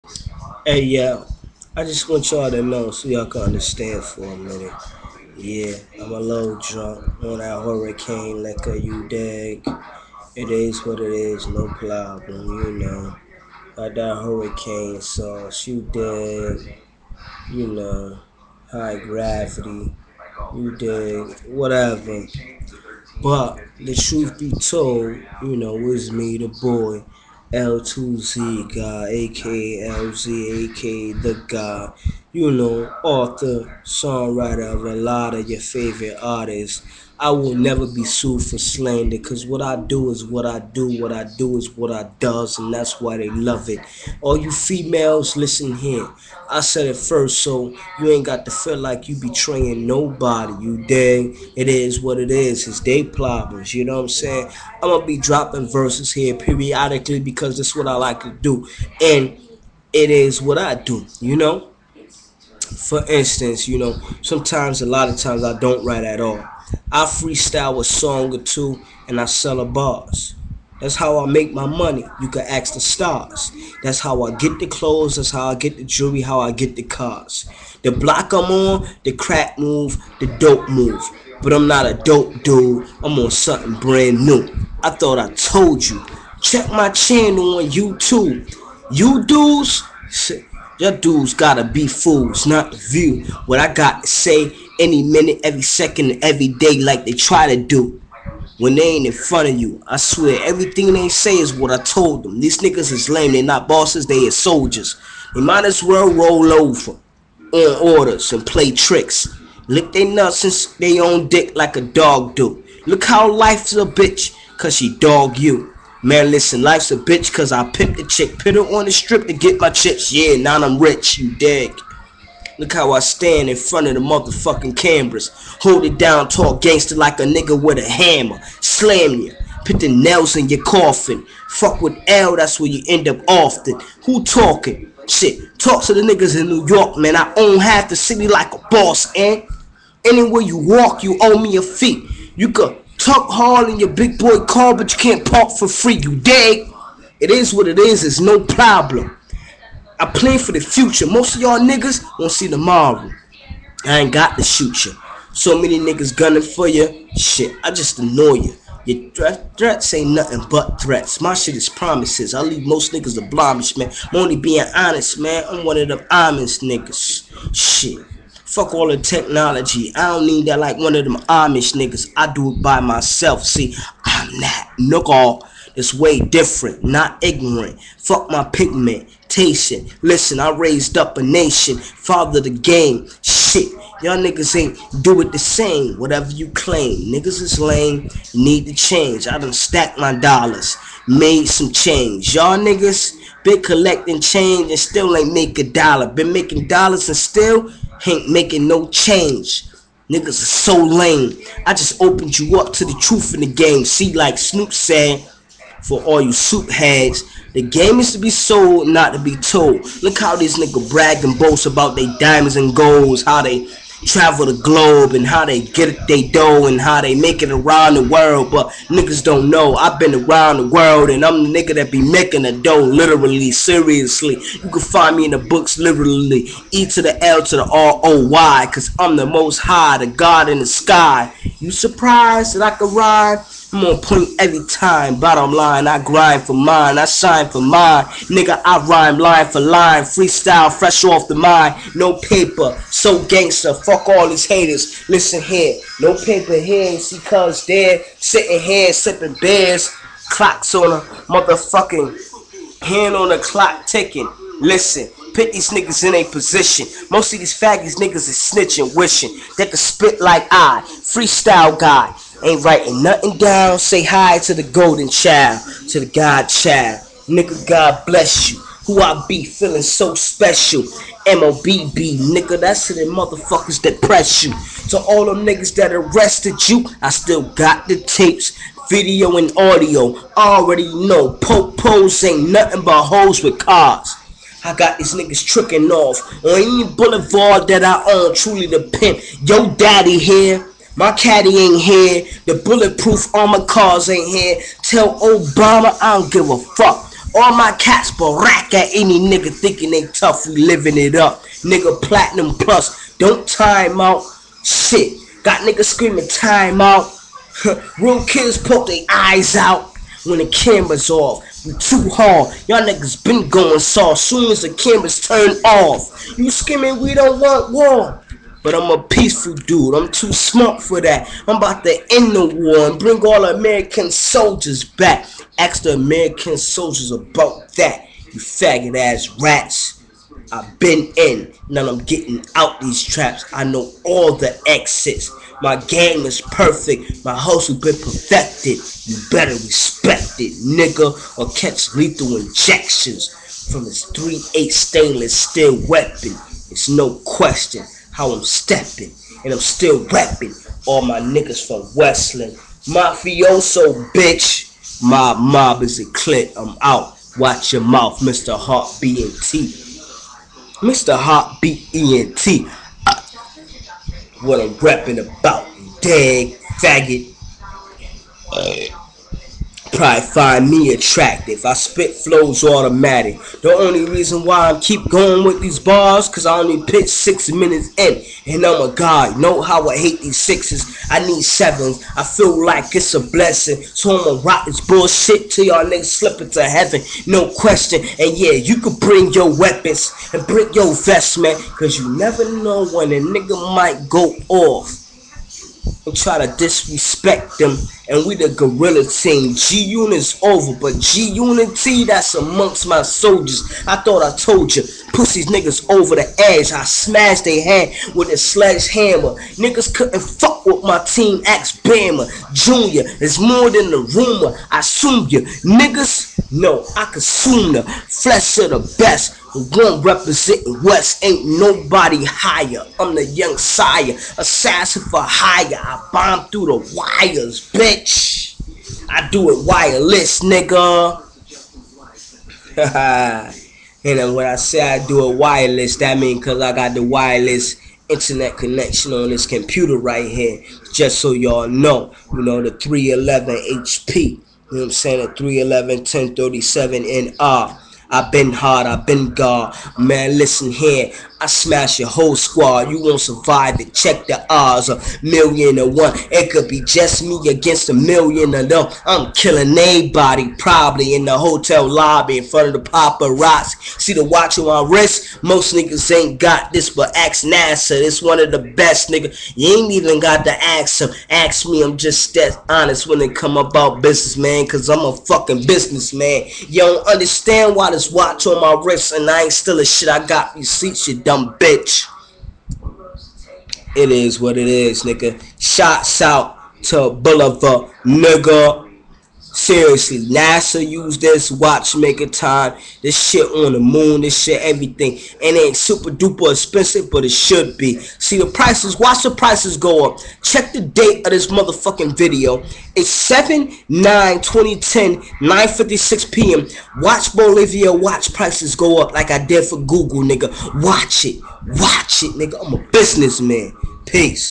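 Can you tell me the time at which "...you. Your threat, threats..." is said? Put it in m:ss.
2:38.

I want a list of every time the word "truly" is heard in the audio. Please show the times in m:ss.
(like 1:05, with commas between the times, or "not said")
4:48.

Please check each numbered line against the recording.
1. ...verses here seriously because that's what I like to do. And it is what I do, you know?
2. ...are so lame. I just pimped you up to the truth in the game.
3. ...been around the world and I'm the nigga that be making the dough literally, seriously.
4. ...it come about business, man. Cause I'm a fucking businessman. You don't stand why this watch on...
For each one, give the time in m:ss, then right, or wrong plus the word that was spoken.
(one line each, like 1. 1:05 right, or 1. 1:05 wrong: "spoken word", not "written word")
1. 0:55 wrong: "periodically", not "seriously"
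2. 3:20 wrong: "opened", not "pimped"
3. 3:39 right
4. 7:53 wrong: "understand", not "stand".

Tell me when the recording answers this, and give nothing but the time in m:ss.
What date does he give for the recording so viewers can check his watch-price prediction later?
8:23.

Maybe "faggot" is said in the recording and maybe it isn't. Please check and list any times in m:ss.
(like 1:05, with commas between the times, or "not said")
4:17, 5:28, 6:06.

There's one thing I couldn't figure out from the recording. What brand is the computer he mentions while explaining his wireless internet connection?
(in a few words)
HP.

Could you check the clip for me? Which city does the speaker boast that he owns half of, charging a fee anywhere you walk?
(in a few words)
New York.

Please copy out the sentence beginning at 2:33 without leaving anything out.
I ain't got to shoot you.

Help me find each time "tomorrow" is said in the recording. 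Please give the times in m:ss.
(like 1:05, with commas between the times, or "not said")
2:32.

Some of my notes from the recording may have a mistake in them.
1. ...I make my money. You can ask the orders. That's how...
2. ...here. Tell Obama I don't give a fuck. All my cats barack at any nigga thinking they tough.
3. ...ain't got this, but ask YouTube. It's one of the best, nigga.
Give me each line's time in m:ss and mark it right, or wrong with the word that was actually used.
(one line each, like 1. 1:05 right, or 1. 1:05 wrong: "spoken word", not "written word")
1. 1:11 wrong: "stars", not "orders"
2. 4:54 right
3. 7:46 wrong: "NASA", not "YouTube".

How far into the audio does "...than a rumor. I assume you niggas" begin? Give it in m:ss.
6:53.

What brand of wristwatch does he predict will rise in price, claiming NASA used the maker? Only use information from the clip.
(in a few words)
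Bulova.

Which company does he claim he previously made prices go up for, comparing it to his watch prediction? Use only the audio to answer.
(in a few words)
Google.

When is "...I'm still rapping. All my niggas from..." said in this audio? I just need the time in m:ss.
5:49.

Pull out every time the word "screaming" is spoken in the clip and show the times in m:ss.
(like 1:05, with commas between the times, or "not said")
5:05, 5:16.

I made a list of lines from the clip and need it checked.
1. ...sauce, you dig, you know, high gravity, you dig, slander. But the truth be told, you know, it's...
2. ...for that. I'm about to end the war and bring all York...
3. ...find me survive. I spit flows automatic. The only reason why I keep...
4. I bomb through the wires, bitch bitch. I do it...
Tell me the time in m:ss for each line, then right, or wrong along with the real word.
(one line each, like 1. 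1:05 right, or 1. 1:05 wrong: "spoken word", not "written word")
1. 0:15 wrong: "whatever", not "slander"
2. 5:20 wrong: "American", not "York"
3. 6:10 wrong: "attractive", not "survive"
4. 7:05 right.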